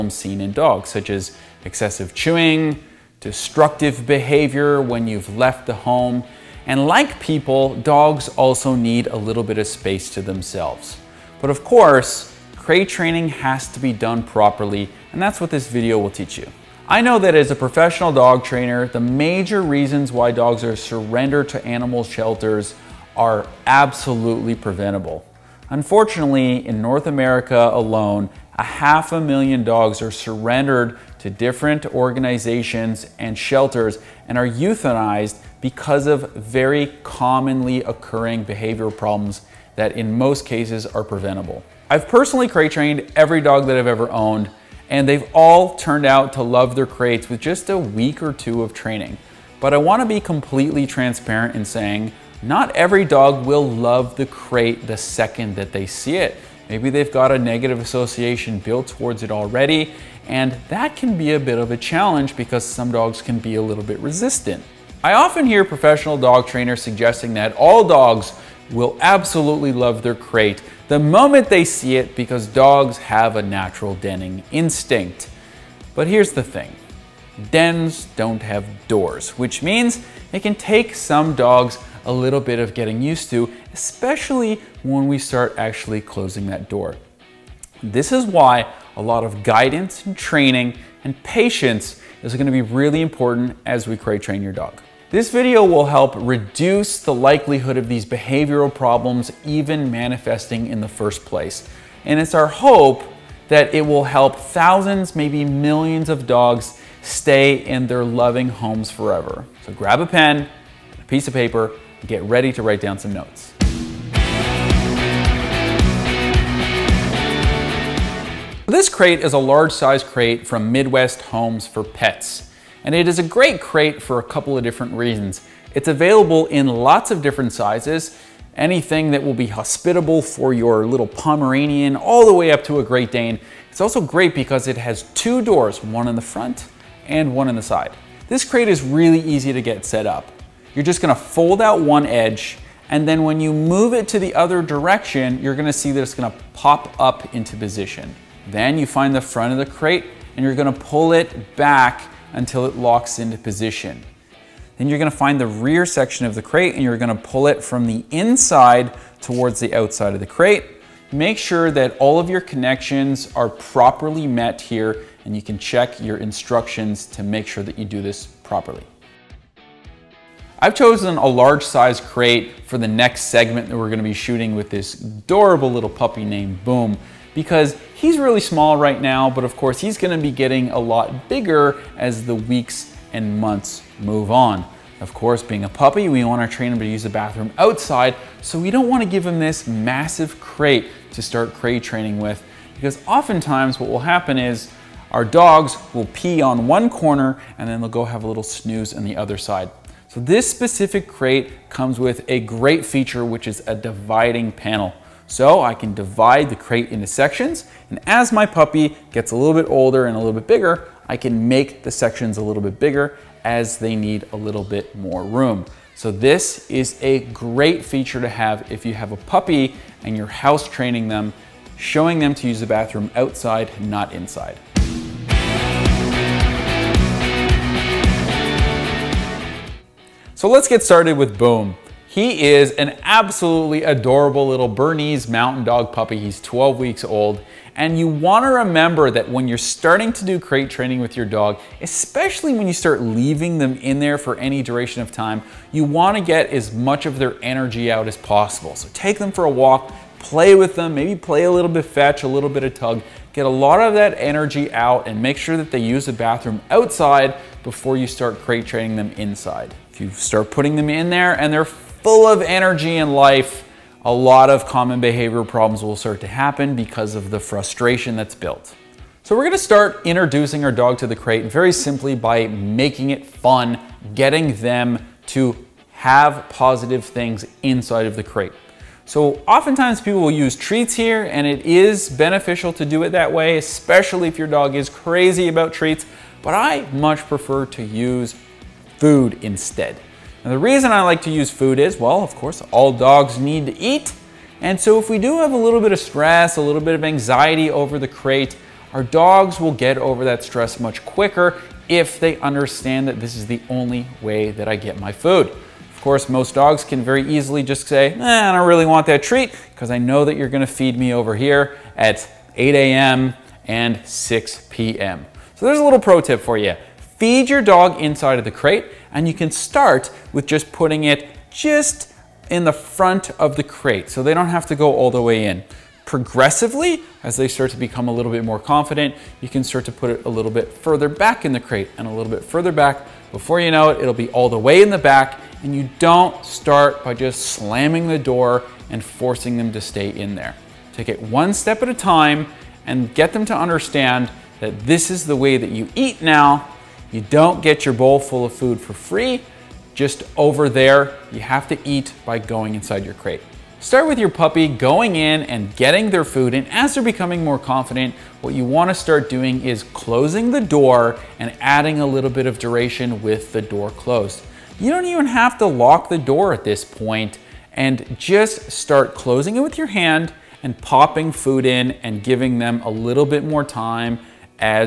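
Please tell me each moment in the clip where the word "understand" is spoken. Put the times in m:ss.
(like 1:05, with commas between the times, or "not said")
5:02, 5:43.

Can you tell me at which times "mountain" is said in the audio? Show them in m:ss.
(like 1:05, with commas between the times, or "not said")
3:55.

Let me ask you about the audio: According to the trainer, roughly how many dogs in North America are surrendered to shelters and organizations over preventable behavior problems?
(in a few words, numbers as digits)
half a million.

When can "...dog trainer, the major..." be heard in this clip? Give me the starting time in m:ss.
0:18.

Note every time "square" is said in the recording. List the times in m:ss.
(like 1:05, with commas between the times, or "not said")
not said.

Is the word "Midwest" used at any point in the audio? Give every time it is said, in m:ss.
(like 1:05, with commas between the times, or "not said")
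2:00.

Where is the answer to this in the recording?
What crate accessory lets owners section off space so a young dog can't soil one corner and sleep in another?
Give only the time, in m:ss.
3:23.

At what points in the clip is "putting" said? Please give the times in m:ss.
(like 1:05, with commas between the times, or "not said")
4:20, 5:20.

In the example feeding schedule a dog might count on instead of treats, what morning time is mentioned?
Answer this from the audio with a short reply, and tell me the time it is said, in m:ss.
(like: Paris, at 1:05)
8 a.m., at 5:12.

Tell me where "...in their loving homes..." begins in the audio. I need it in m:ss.
1:47.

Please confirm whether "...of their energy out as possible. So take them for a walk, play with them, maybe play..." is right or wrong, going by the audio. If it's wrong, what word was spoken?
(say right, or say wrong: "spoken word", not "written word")
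right.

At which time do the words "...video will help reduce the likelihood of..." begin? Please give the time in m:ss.
1:35.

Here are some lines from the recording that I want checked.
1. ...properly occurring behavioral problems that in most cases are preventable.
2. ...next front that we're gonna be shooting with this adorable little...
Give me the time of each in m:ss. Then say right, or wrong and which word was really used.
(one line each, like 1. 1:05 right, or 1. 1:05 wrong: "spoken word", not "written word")
1. 0:37 wrong: "commonly", not "properly"
2. 2:52 wrong: "segment", not "front".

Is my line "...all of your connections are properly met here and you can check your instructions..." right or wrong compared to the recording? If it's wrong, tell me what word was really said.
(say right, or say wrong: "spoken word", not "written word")
right.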